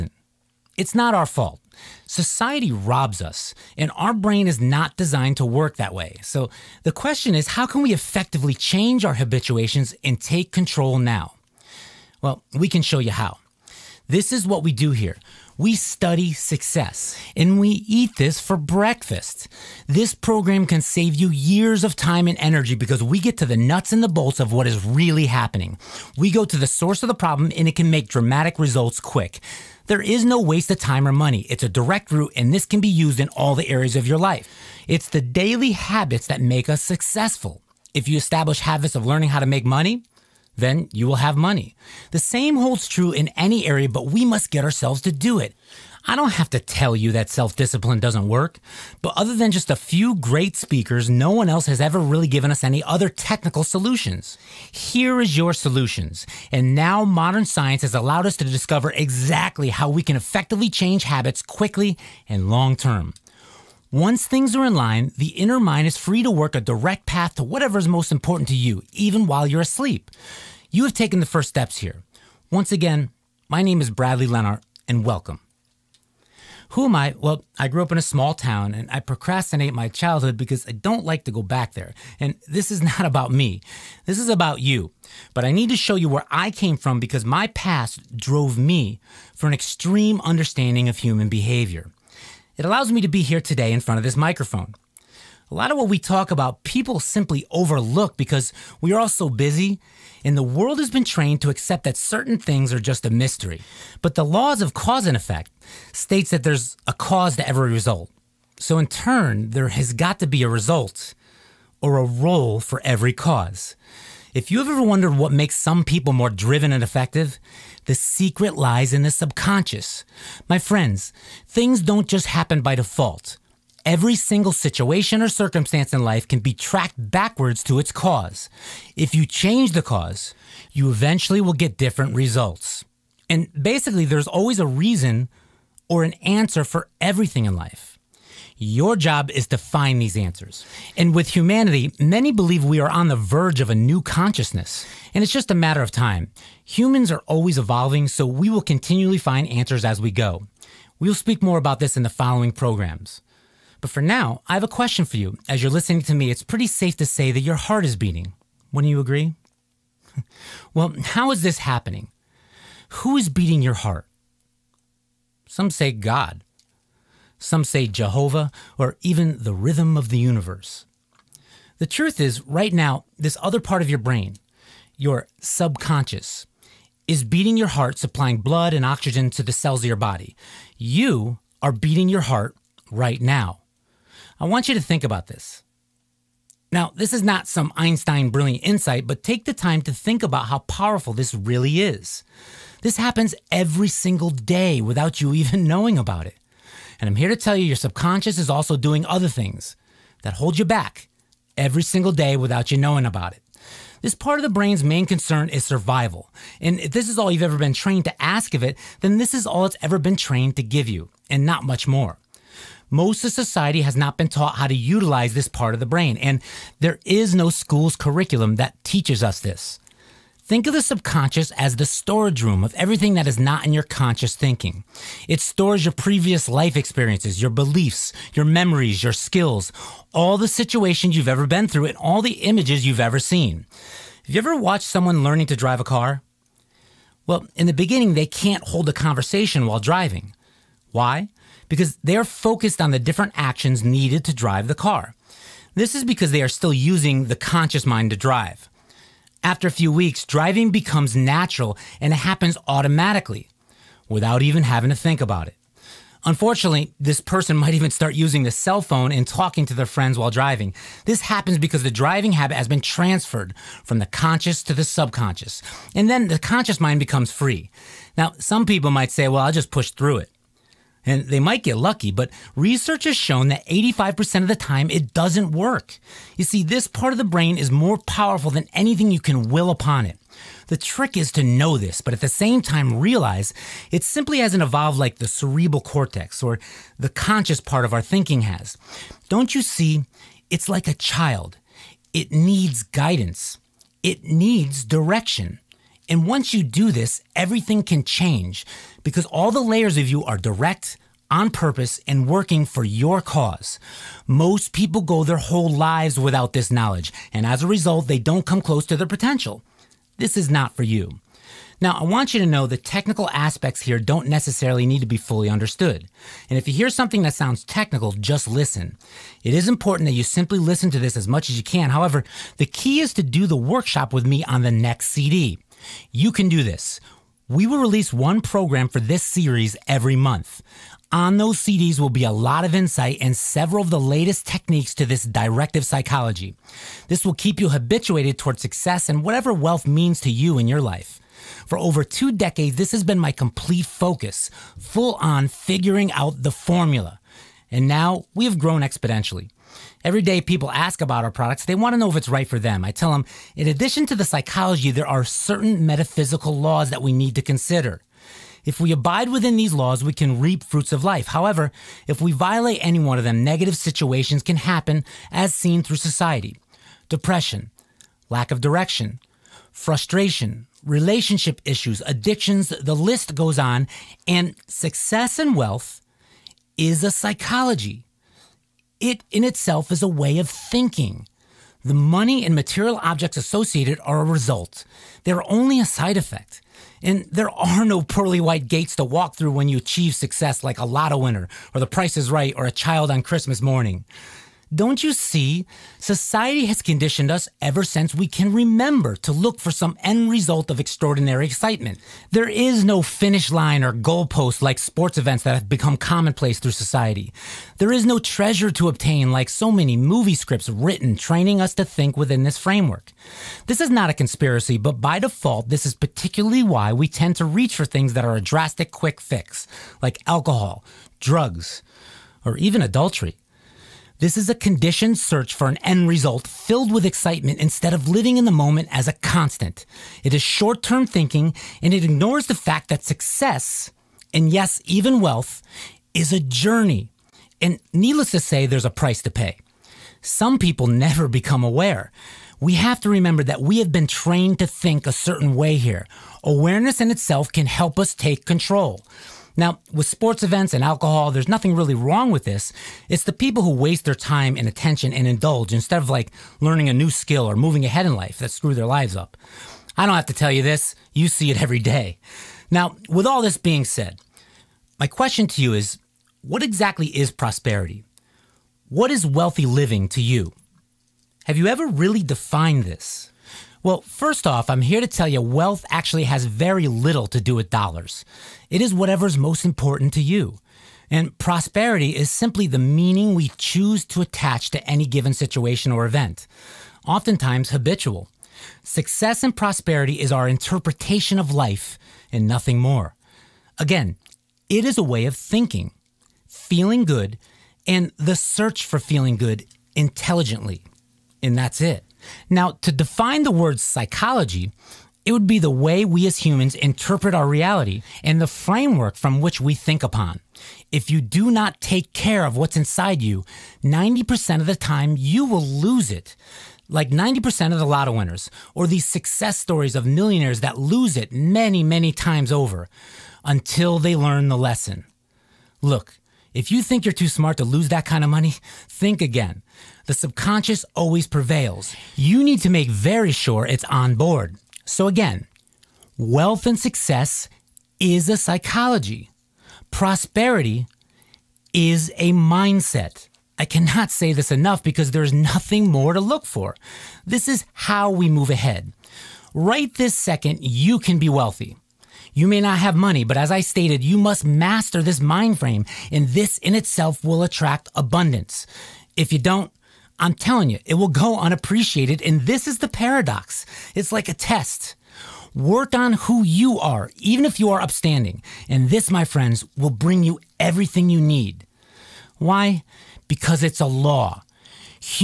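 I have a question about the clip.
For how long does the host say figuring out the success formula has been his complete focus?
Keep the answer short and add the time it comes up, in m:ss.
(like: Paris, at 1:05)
over two decades, at 5:41.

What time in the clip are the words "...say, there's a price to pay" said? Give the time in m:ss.
7:18.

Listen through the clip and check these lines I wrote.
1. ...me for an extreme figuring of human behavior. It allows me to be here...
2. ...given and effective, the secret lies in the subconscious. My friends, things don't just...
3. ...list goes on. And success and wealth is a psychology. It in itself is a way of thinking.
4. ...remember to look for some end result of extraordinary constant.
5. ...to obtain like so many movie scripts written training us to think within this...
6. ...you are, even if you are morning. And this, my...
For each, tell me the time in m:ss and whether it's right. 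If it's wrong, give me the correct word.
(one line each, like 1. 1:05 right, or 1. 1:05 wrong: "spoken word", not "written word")
1. 1:28 wrong: "understanding", not "figuring"
2. 1:56 wrong: "driven", not "given"
3. 6:12 right
4. 6:38 wrong: "excitement", not "constant"
5. 6:48 right
6. 9:26 wrong: "upstanding", not "morning".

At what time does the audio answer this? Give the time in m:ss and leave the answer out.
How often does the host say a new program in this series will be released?
5:29.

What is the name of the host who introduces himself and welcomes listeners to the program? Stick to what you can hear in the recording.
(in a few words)
Bradley Lenart.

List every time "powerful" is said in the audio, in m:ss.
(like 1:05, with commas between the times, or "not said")
3:10, 4:37.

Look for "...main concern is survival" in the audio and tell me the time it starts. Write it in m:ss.
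3:24.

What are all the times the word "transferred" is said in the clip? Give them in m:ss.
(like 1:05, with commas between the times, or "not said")
4:22.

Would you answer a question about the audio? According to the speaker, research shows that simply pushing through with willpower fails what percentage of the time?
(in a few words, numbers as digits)
85%.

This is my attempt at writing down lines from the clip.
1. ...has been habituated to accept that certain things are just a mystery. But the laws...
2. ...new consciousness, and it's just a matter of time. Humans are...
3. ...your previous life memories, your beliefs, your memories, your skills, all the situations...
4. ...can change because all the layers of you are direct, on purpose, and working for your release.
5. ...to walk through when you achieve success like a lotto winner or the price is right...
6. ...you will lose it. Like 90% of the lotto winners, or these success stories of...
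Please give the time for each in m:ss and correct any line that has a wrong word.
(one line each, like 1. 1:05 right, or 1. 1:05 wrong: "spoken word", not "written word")
1. 1:40 wrong: "trained", not "habituated"
2. 2:23 right
3. 3:45 wrong: "experiences", not "memories"
4. 4:57 wrong: "cause", not "release"
5. 6:28 right
6. 8:35 right.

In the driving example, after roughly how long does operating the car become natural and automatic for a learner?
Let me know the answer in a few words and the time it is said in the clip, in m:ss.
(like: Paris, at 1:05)
a few weeks, at 4:09.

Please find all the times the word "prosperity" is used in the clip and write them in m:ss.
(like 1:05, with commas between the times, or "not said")
7:47, 8:01, 8:09, 8:59.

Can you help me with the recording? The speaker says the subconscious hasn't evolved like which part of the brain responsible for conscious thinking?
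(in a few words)
cerebral cortex.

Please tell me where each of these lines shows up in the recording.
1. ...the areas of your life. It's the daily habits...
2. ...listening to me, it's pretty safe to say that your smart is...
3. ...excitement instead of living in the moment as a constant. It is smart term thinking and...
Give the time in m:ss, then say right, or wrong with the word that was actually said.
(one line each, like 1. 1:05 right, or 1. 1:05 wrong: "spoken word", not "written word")
1. 0:33 right
2. 2:35 wrong: "heart", not "smart"
3. 7:07 wrong: "short", not "smart".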